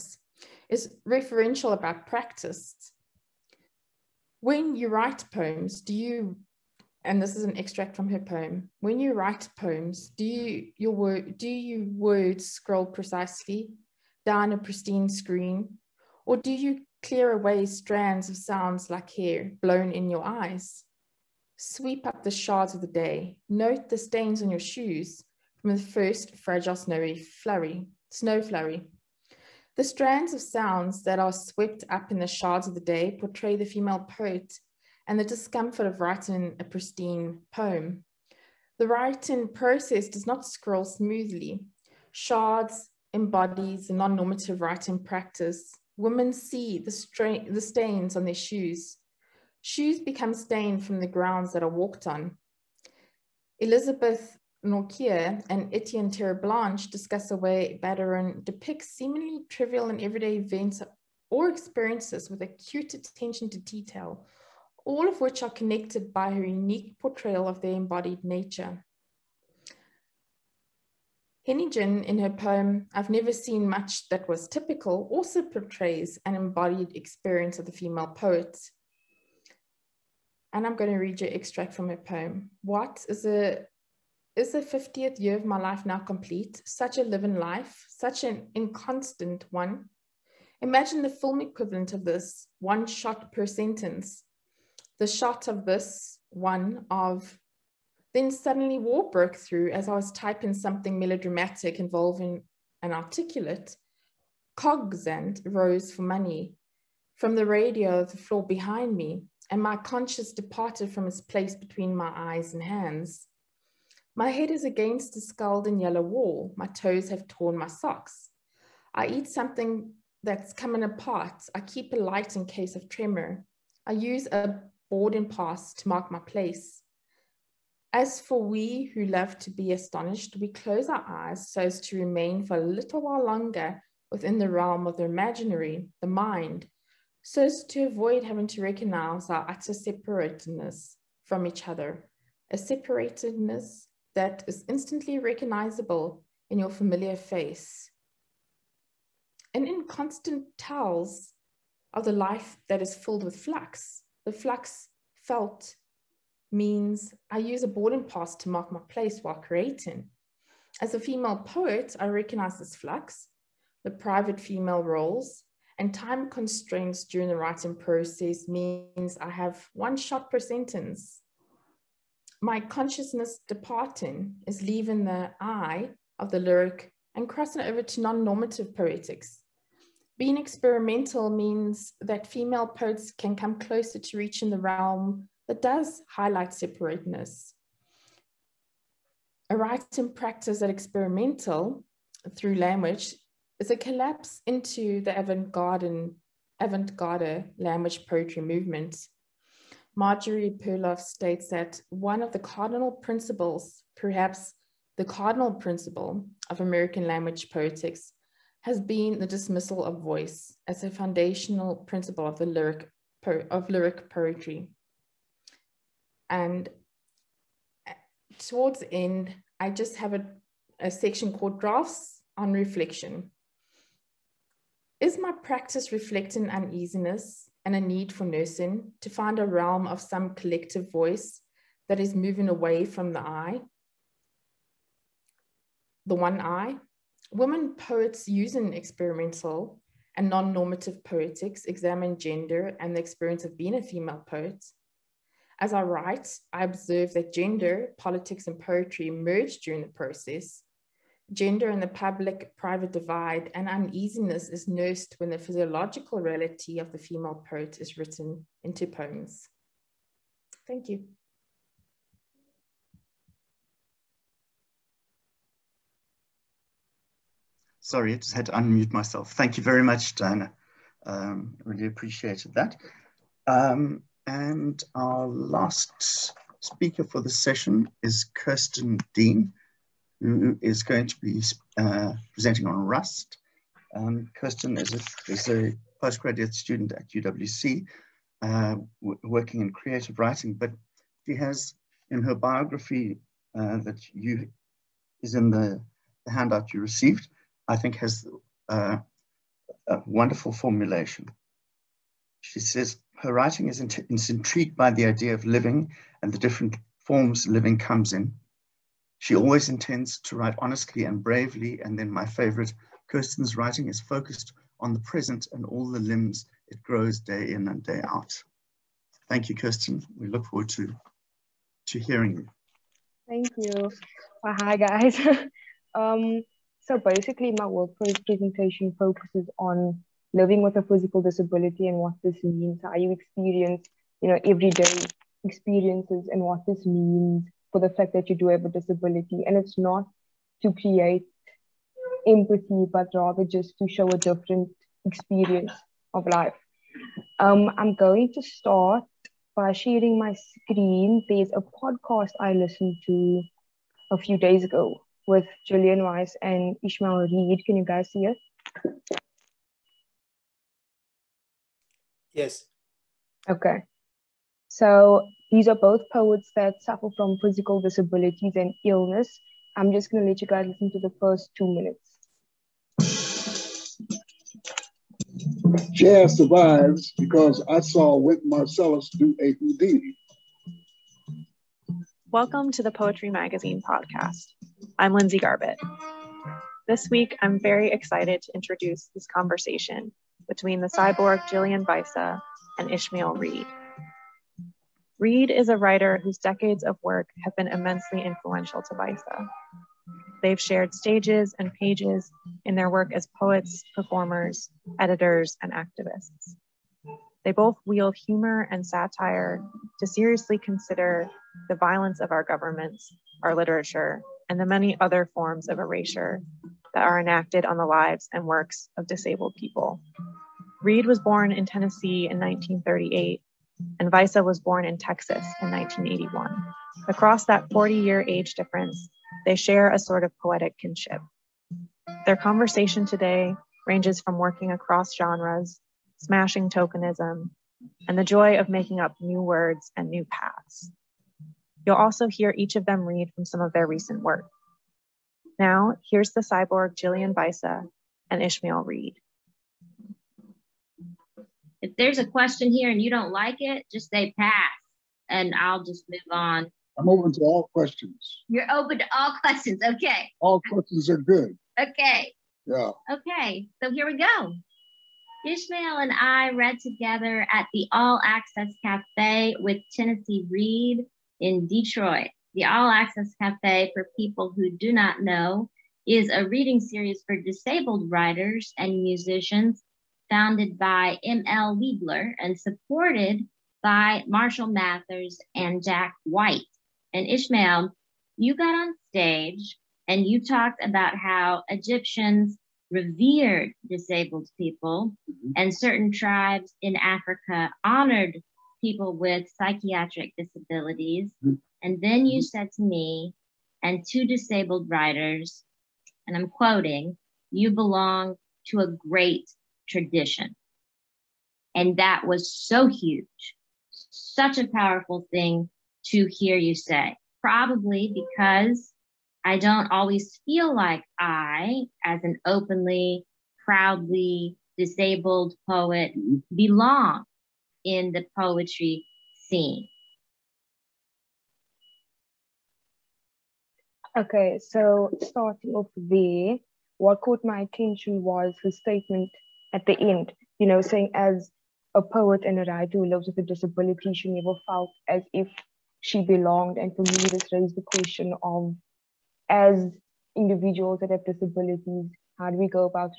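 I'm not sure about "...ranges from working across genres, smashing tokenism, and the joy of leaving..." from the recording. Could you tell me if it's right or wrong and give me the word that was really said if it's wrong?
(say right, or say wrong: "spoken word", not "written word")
wrong: "making", not "leaving".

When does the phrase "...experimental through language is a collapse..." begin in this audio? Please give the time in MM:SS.
03:10.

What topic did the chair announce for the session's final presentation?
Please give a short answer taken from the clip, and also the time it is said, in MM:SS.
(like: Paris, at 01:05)
Rust, at 04:42.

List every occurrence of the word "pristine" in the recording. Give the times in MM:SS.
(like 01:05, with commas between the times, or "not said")
00:14, 00:36.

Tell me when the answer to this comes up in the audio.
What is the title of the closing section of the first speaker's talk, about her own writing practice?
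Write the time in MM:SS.
03:41.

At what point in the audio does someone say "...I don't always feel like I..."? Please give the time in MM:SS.
08:39.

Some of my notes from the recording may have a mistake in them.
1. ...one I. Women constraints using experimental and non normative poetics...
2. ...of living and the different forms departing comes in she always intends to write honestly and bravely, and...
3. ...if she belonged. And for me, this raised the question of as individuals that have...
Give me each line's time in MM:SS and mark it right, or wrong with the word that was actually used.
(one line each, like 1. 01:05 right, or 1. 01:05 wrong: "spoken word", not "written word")
1. 03:56 wrong: "poets", not "constraints"
2. 05:05 wrong: "living", not "departing"
3. 09:05 right.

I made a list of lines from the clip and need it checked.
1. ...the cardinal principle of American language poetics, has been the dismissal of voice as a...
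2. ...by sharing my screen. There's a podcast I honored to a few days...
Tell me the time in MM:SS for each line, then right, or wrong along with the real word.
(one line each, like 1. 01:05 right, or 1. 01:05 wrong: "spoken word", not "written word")
1. 03:24 right
2. 05:49 wrong: "listened", not "honored".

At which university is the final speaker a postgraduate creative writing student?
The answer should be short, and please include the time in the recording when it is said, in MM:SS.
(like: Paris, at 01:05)
UWC, at 04:47.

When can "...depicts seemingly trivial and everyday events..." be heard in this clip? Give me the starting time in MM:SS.
00:58.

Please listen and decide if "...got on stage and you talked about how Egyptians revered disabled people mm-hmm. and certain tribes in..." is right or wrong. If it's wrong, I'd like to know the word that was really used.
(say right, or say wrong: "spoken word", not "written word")
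right.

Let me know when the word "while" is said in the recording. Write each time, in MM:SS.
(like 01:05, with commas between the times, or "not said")
02:13, 02:39.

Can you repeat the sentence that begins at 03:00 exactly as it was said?
Being experimental means that female poets can come closer to reaching the realm that does highlight separateness.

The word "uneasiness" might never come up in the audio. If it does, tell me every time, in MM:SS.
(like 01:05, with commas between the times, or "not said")
03:46, 04:13.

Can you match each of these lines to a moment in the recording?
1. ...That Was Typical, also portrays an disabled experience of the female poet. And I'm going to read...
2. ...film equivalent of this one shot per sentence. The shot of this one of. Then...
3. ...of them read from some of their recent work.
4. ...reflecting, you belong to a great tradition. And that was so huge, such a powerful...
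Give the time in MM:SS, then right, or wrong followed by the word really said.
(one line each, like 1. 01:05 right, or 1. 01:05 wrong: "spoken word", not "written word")
1. 01:14 wrong: "embodied", not "disabled"
2. 01:31 right
3. 07:22 right
4. 08:26 wrong: "quoting", not "reflecting".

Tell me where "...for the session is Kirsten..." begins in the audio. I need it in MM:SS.
04:37.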